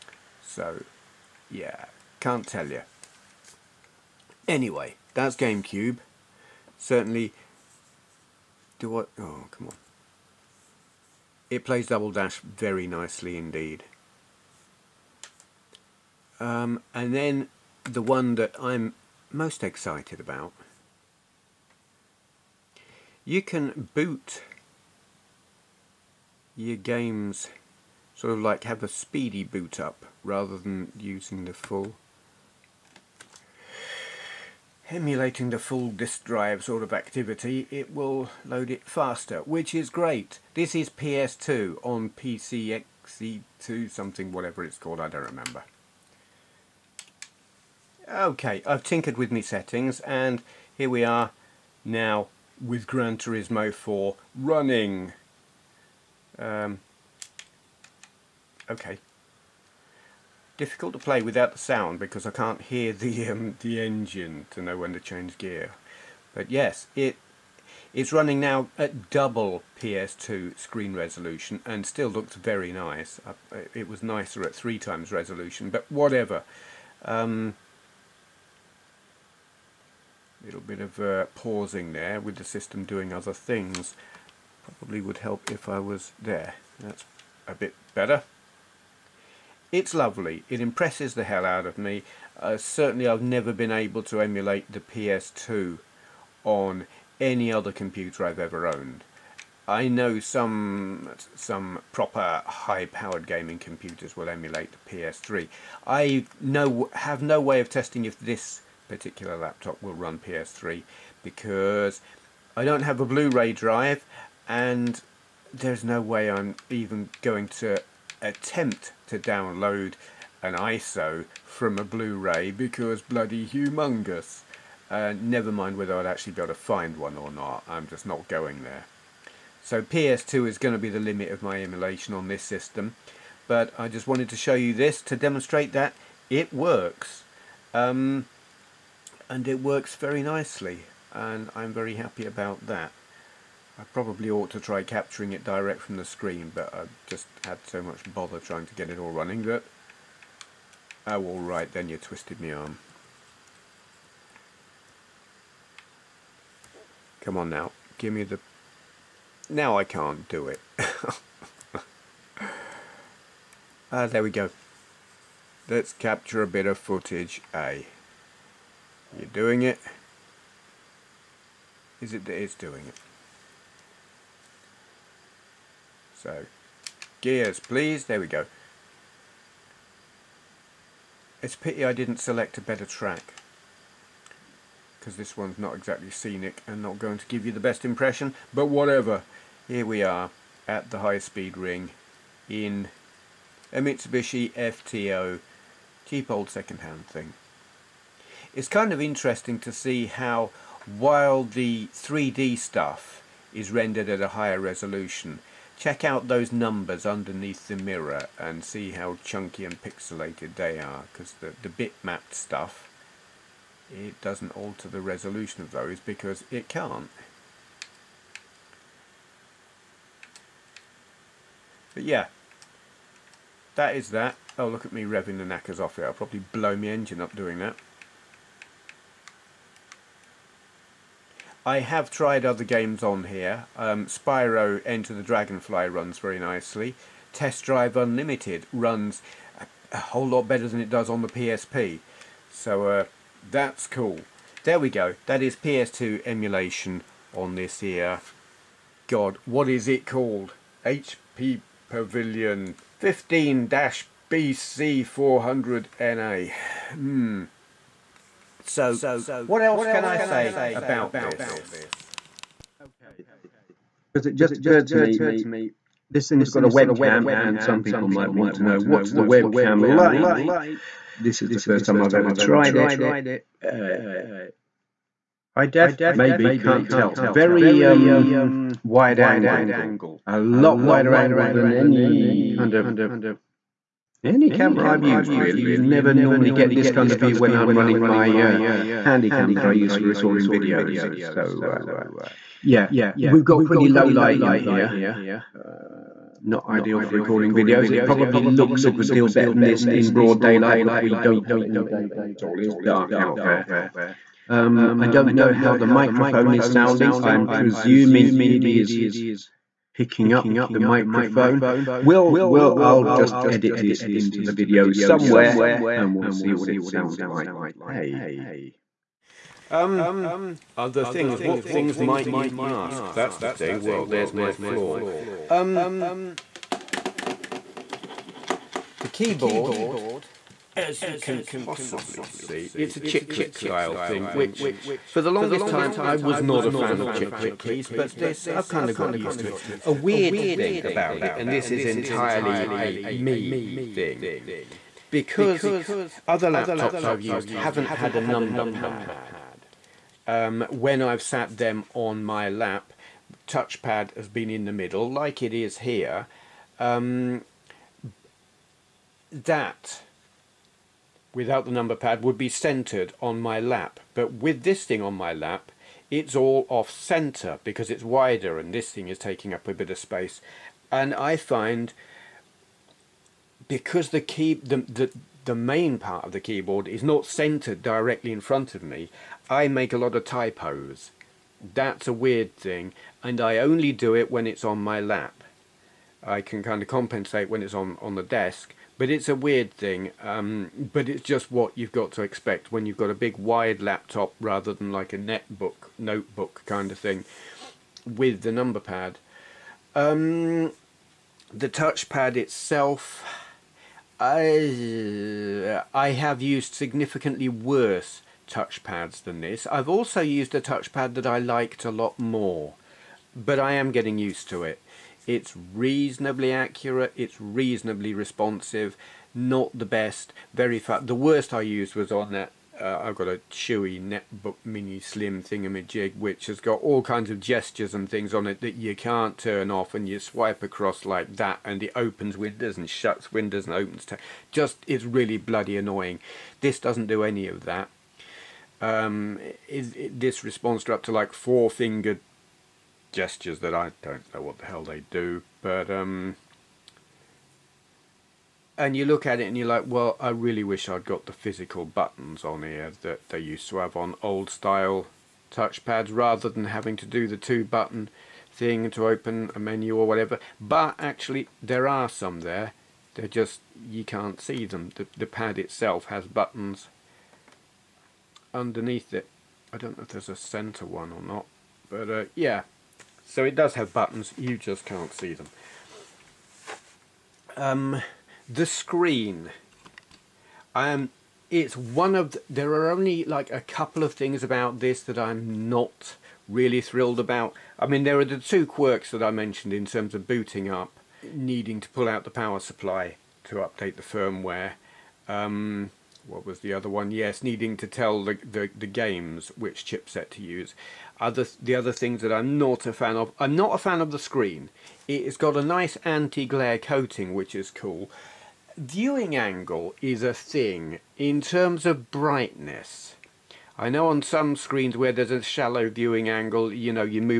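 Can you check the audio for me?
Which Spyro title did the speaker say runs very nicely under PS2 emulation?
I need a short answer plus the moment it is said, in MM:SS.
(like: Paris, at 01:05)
Spyro Enter the Dragonfly, at 03:54.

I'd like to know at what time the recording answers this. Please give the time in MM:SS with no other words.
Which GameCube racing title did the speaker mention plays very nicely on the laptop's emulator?
00:11.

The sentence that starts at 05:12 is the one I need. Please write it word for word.
We'll, we'll, I'll just edit this into the video somewhere and we'll see what it sounds like.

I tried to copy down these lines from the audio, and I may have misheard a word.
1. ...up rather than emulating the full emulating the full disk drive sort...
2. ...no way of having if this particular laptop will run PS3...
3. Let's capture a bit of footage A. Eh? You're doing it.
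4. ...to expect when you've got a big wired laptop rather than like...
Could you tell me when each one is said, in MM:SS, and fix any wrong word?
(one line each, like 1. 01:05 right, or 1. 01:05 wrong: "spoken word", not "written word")
1. 00:29 wrong: "using", not "emulating"
2. 01:47 wrong: "testing", not "having"
3. 02:45 right
4. 06:32 right.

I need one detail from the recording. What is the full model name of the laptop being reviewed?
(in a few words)
HP Pavilion 15-BC400NA.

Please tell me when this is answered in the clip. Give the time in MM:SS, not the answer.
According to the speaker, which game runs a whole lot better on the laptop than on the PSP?
03:57.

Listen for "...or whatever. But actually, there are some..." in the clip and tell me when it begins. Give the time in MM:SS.
07:39.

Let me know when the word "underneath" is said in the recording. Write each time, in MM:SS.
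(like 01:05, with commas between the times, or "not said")
03:27, 07:48.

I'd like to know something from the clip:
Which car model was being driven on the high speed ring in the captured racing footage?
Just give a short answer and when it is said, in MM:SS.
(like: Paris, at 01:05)
Mitsubishi FTO, at 03:13.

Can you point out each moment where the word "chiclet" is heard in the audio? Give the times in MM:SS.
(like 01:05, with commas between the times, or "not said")
05:33, 05:37.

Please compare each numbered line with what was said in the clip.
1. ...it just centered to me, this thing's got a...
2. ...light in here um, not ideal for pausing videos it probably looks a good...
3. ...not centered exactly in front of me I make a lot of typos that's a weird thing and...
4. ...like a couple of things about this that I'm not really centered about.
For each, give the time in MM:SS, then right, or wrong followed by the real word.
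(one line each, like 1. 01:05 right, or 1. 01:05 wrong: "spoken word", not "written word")
1. 04:24 wrong: "occurred", not "centered"
2. 04:54 wrong: "recording", not "pausing"
3. 06:17 wrong: "directly", not "exactly"
4. 08:03 wrong: "thrilled", not "centered".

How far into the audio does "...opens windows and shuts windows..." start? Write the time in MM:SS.
07:11.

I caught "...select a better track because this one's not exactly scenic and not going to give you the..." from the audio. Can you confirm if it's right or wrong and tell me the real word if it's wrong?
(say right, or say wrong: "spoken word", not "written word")
right.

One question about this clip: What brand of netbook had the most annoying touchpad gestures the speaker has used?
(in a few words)
Chuwi.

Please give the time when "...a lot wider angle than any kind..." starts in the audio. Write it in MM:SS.
04:40.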